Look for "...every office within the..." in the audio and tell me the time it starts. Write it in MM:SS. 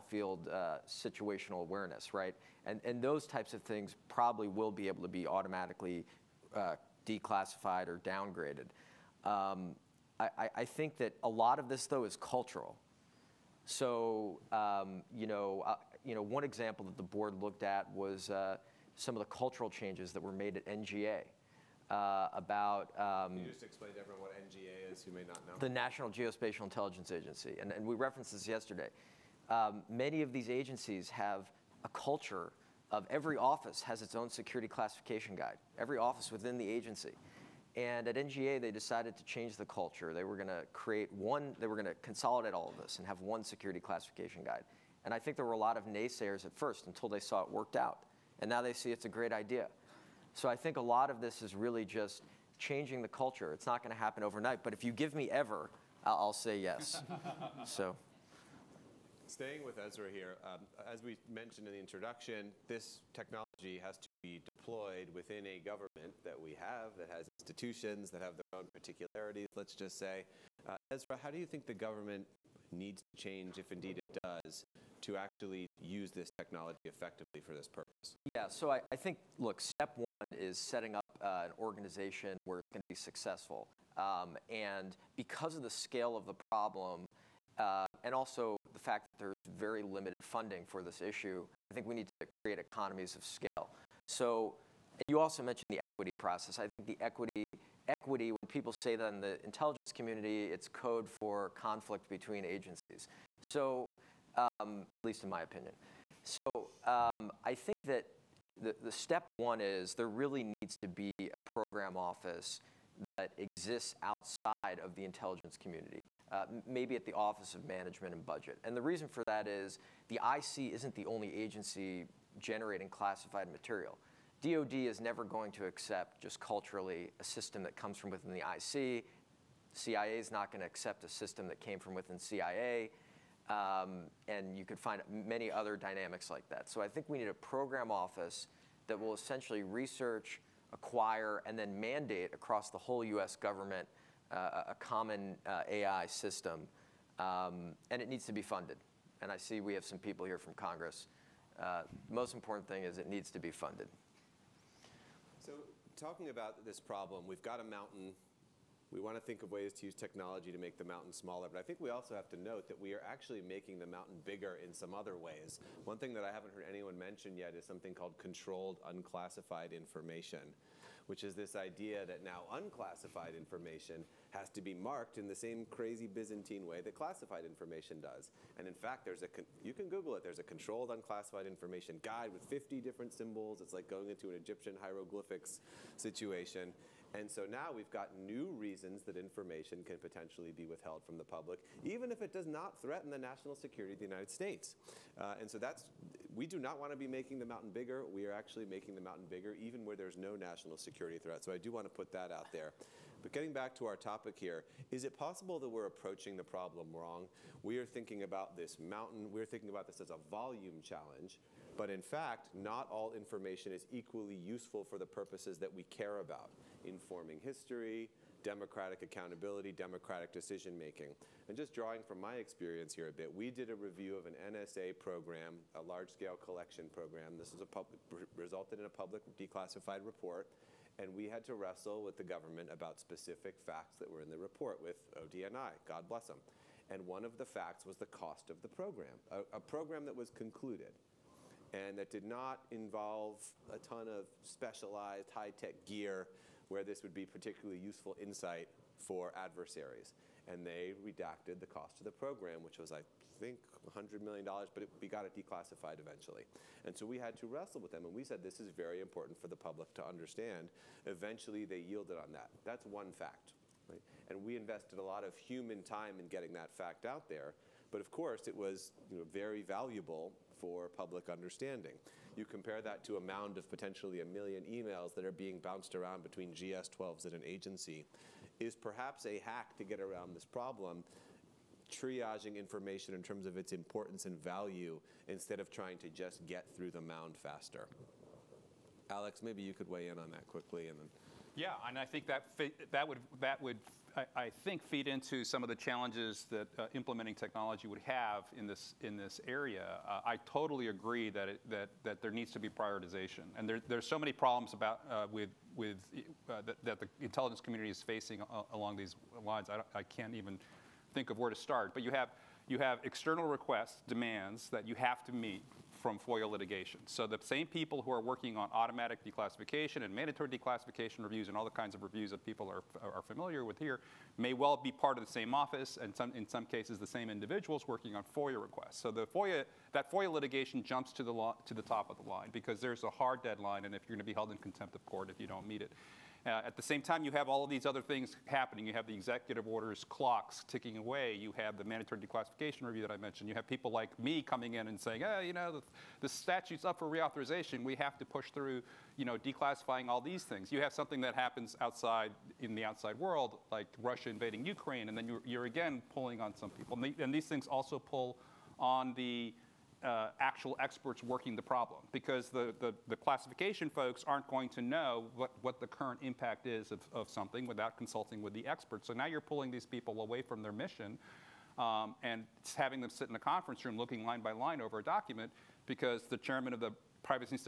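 00:35.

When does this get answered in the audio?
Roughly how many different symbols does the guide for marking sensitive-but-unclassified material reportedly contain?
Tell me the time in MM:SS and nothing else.
03:02.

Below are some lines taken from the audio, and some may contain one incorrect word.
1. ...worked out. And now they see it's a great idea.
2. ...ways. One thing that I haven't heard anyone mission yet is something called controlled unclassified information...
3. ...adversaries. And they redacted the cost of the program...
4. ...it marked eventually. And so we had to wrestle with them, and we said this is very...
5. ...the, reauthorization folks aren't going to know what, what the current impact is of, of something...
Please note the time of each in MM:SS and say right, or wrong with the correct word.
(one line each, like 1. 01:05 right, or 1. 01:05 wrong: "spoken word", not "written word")
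1. 00:47 right
2. 02:45 wrong: "mention", not "mission"
3. 04:09 right
4. 04:15 wrong: "declassified", not "marked"
5. 06:03 wrong: "classification", not "reauthorization".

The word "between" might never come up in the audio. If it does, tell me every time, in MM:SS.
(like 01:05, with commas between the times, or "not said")
01:42, 04:36.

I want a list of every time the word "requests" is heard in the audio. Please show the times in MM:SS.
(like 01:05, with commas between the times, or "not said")
05:13, 05:28.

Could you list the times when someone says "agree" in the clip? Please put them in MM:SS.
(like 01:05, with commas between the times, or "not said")
05:00.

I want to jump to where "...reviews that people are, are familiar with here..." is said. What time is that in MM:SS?
05:22.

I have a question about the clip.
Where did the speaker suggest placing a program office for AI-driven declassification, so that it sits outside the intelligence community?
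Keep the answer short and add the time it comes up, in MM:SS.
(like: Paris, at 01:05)
Office of Management and Budget, at 01:57.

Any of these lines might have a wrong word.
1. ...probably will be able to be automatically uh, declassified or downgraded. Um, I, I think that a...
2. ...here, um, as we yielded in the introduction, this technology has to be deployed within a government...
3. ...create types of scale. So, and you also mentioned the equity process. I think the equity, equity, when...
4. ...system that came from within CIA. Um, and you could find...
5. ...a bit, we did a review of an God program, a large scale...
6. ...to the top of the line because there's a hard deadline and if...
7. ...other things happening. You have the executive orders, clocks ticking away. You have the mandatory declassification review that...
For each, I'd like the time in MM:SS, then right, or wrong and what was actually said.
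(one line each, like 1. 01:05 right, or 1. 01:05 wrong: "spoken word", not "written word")
1. 00:04 right
2. 01:00 wrong: "mentioned", not "yielded"
3. 01:32 wrong: "economies", not "types"
4. 02:11 right
5. 03:43 wrong: "NSA", not "God"
6. 05:31 right
7. 05:37 right.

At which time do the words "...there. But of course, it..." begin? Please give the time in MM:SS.
04:27.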